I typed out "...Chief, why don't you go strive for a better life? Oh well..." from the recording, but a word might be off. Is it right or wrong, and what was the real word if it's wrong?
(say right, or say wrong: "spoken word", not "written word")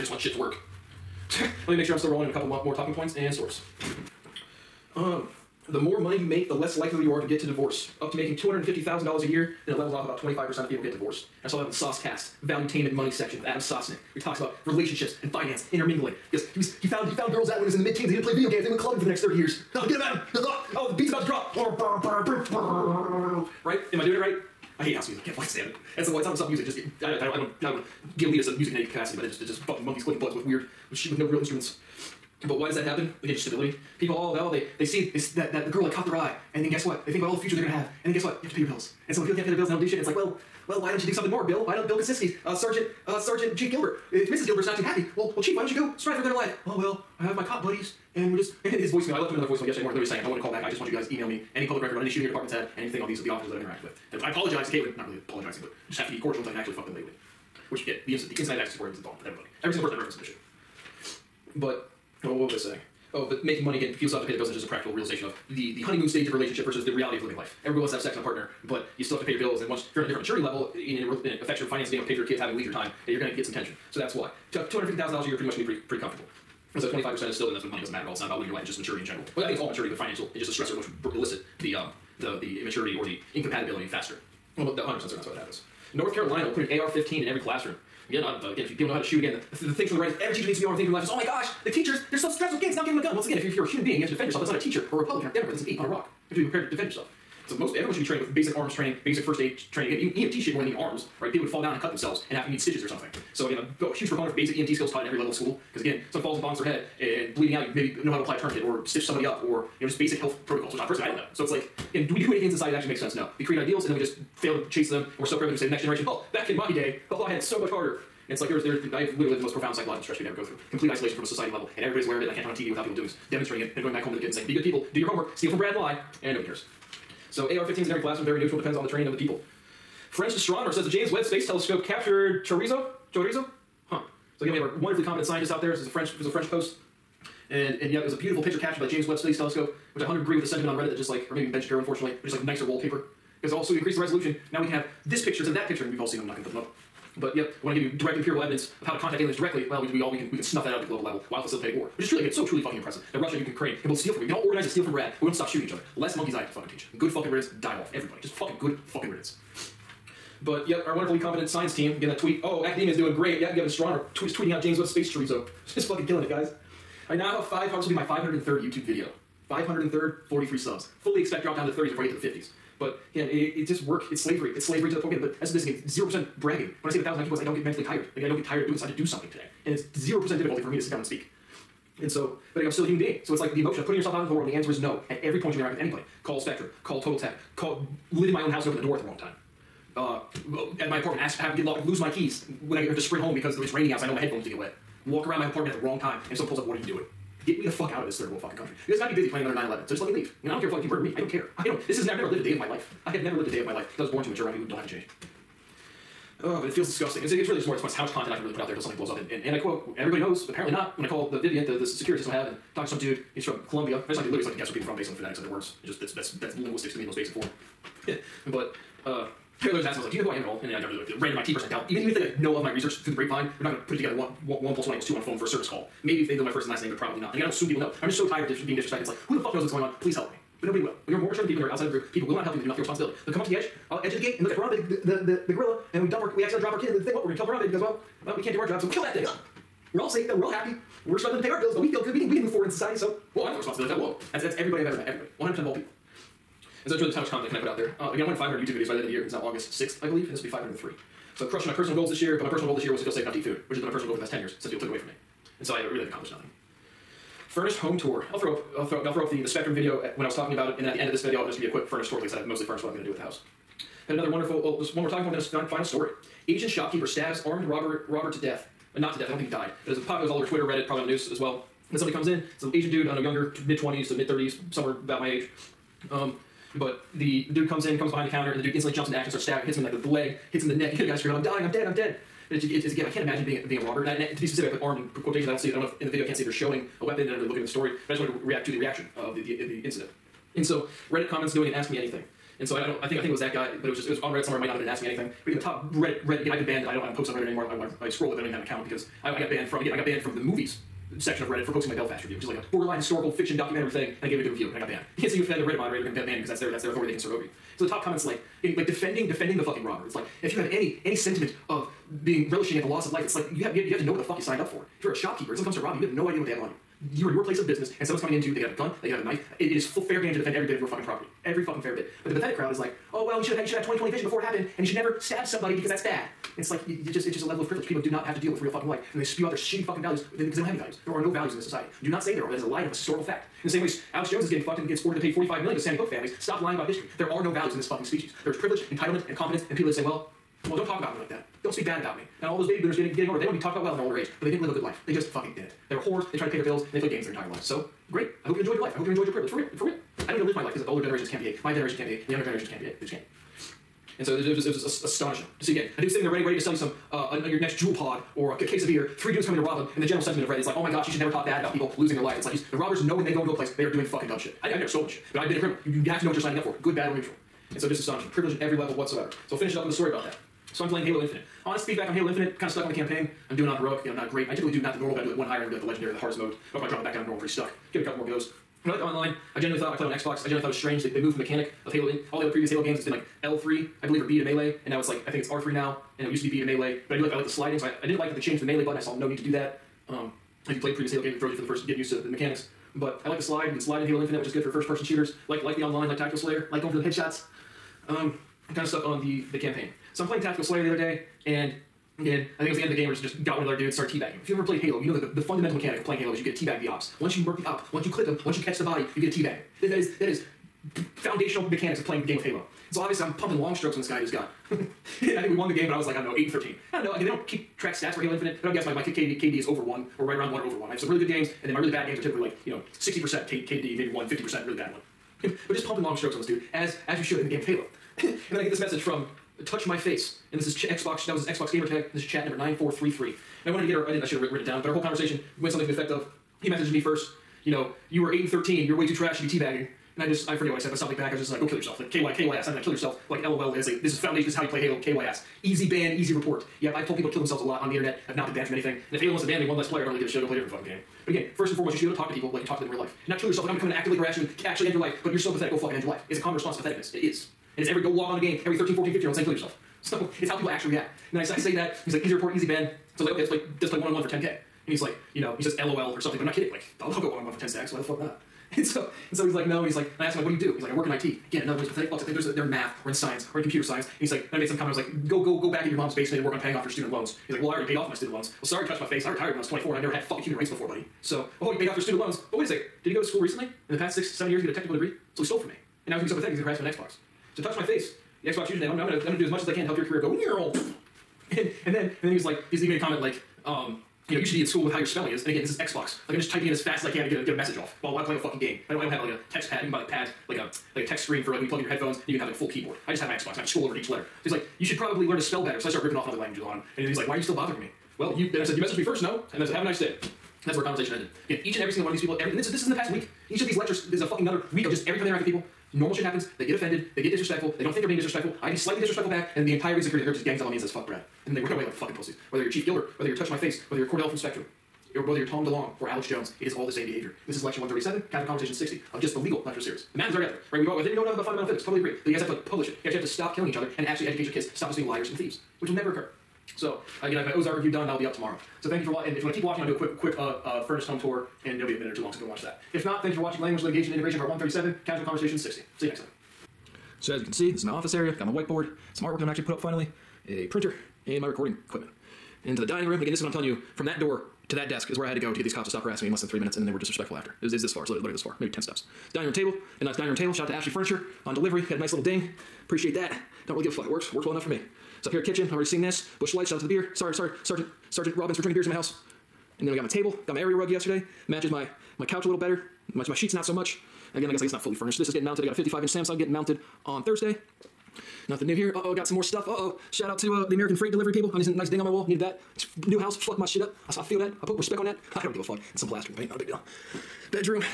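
right.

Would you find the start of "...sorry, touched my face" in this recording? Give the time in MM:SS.
07:58.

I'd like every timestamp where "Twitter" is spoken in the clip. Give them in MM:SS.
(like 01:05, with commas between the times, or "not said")
04:30.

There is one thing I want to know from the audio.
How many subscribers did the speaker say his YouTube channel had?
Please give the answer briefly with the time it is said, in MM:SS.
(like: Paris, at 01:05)
43, at 02:50.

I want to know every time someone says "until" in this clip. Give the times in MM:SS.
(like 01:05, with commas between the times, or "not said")
00:56, 03:28.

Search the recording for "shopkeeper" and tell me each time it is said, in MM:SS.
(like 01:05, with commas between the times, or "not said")
04:26, 05:15.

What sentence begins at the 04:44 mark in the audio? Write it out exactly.
And, I, and to be specific, I put armed in quotations.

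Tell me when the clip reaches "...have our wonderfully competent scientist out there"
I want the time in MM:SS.
02:14.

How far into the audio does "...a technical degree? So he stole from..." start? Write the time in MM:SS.
08:04.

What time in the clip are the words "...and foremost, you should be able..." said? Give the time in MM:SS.
07:31.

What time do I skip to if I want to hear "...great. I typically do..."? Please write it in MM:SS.
06:14.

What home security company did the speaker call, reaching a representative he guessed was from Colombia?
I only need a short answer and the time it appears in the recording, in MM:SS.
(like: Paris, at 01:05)
Vivint, at 03:31.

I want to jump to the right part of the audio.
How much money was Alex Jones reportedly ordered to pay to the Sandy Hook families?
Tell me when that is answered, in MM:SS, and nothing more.
05:35.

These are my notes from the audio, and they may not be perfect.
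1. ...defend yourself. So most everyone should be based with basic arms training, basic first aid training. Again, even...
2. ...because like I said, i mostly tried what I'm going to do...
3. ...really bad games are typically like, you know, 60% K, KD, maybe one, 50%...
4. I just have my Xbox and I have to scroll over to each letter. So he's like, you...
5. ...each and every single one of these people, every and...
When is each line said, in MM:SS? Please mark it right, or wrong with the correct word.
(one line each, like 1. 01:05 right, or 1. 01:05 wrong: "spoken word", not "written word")
1. 01:36 wrong: "trained", not "based"
2. 04:22 wrong: "furnished", not "tried"
3. 07:01 right
4. 08:23 right
5. 08:31 right.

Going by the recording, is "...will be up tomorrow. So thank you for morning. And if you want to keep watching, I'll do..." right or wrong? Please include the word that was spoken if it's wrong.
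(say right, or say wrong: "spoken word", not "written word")
wrong: "watching", not "morning".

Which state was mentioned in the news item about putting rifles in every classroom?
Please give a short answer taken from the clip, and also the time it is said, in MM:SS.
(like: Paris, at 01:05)
North Carolina, at 01:25.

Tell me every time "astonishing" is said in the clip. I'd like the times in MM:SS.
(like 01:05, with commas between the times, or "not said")
05:55, 06:07.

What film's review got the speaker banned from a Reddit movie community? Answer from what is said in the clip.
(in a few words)
Belfast.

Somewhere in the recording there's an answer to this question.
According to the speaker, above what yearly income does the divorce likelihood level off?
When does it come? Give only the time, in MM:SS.
00:08.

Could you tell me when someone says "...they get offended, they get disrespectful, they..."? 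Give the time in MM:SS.
08:36.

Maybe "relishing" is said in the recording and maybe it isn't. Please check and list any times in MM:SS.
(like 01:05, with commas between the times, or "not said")
05:12.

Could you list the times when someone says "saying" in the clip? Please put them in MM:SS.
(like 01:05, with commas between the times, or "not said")
00:50, 01:02, 02:04, 07:39.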